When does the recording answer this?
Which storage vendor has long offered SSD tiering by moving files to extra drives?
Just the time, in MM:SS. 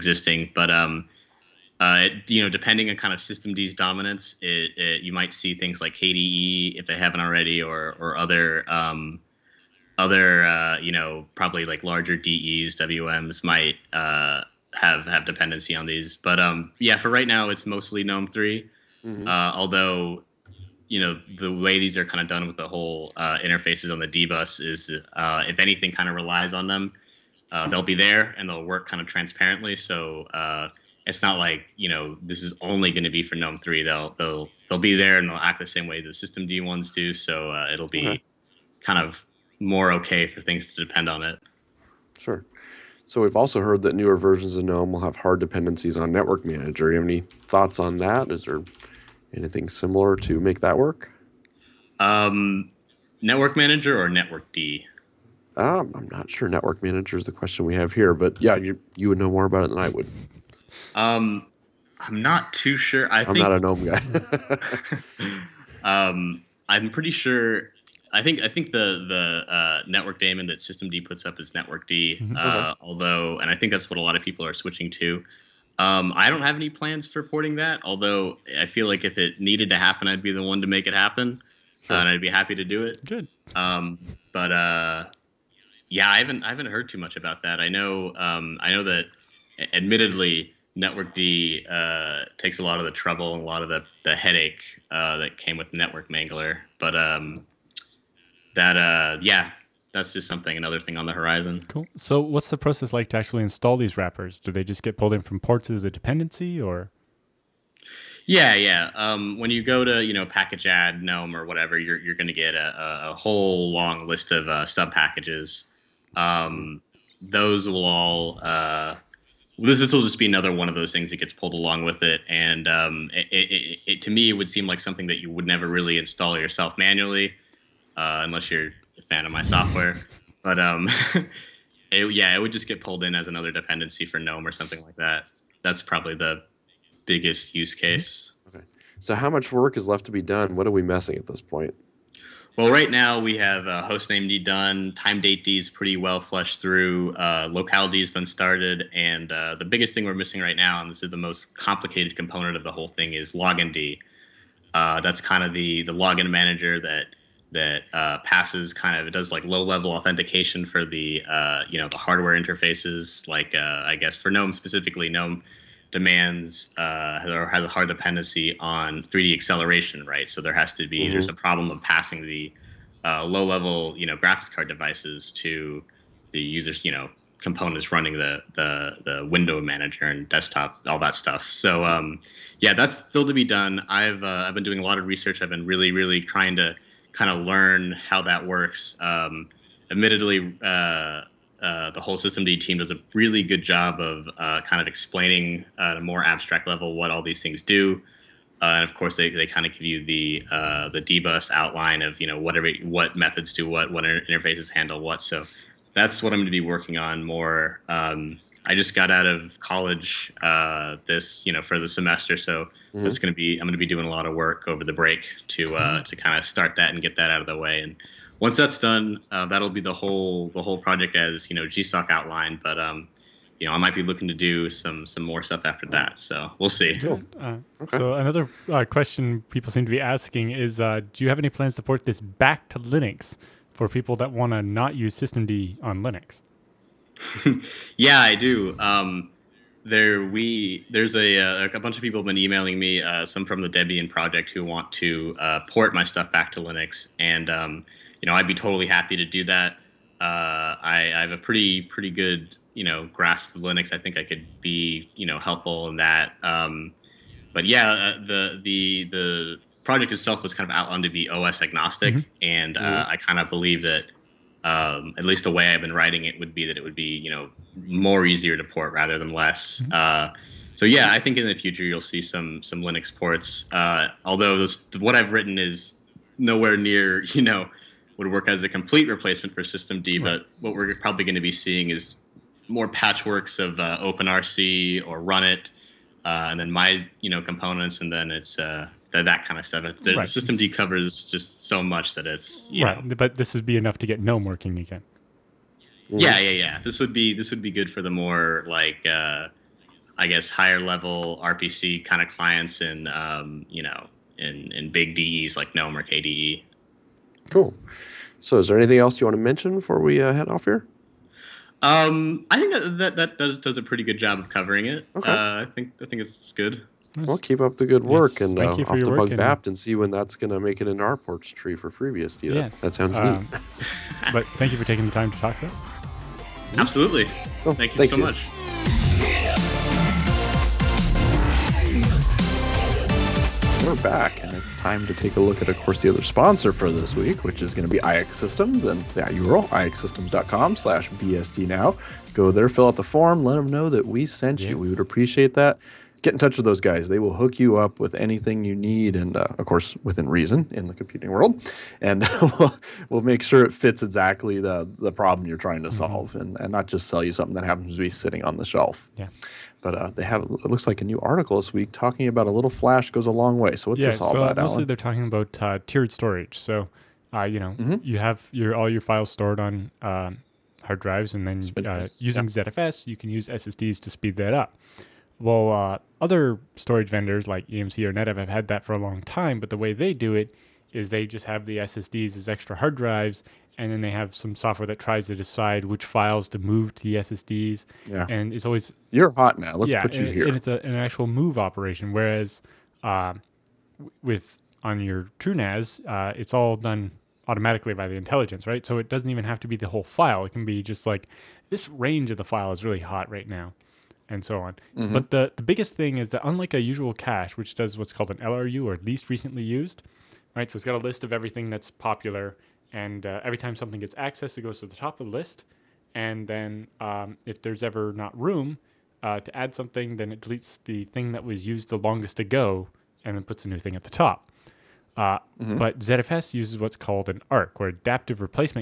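06:18.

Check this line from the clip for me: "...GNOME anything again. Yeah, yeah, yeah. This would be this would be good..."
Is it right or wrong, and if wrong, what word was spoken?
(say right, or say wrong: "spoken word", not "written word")
wrong: "working", not "anything".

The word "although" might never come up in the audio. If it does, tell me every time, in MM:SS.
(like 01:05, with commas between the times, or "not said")
00:19, 01:12, 01:17, 04:34.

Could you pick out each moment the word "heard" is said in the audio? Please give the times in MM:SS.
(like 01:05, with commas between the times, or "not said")
00:43, 01:26.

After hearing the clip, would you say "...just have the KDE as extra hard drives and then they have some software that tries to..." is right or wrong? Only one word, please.
wrong.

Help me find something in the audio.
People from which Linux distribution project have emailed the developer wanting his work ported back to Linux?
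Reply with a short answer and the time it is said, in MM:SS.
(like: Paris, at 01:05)
Debian, at 04:03.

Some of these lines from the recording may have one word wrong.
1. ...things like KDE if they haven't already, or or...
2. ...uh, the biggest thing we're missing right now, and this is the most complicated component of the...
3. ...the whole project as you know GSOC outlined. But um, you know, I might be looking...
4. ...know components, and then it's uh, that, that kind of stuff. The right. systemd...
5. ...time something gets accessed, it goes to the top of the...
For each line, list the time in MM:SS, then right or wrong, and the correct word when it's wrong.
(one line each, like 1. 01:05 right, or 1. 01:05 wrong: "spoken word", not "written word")
1. 00:05 right
2. 02:29 right
3. 03:40 right
4. 04:47 right
5. 06:53 right.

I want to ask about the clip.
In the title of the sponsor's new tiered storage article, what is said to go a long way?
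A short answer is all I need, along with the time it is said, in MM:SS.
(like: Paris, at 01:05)
flash, at 06:02.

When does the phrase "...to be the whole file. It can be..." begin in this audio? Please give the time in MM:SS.
06:39.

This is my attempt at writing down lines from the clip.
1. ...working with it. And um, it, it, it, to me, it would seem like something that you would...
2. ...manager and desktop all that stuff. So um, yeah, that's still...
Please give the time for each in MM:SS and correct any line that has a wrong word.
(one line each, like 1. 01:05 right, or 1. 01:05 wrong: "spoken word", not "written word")
1. 02:01 wrong: "along", not "working"
2. 02:59 right.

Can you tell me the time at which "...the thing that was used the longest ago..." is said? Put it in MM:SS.
07:00.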